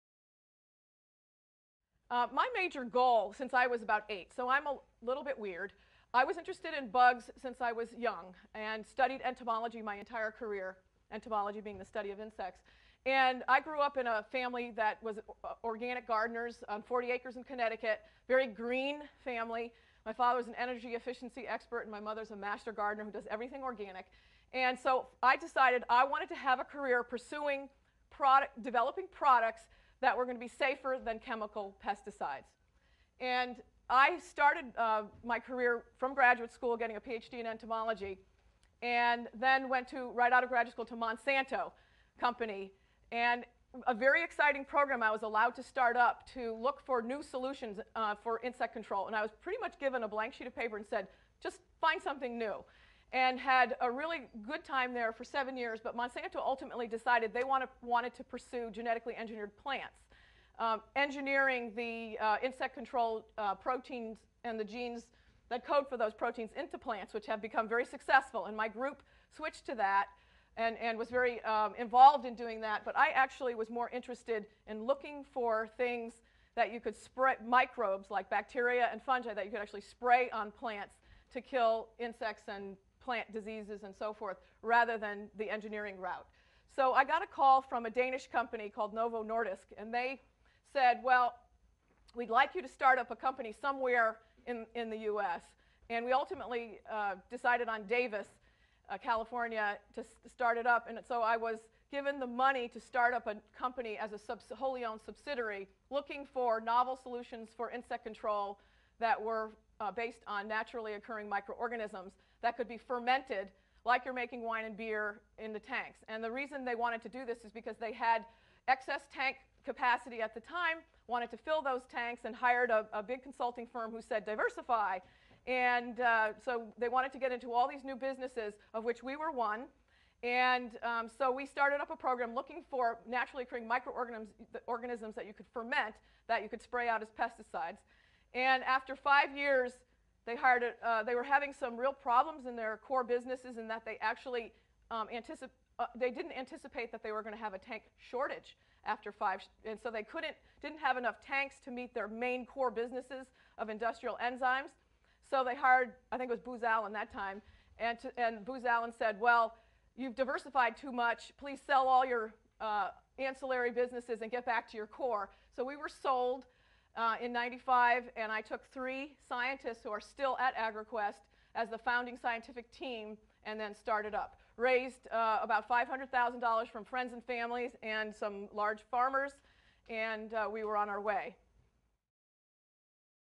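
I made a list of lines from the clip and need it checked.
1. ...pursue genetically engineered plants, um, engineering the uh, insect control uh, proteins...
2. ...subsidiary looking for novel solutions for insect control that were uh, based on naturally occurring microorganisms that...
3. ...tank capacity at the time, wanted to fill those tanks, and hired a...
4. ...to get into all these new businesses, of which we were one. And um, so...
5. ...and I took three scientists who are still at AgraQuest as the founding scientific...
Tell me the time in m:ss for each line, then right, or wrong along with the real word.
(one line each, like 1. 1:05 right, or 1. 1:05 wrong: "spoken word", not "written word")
1. 0:58 right
2. 1:45 right
3. 1:59 right
4. 2:07 right
5. 2:48 right.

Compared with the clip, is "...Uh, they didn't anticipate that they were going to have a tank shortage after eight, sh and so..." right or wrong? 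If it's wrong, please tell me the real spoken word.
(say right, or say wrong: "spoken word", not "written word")
wrong: "five", not "eight".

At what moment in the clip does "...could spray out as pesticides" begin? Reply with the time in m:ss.
2:16.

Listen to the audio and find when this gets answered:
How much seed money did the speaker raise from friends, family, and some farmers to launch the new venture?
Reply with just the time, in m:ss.
2:55.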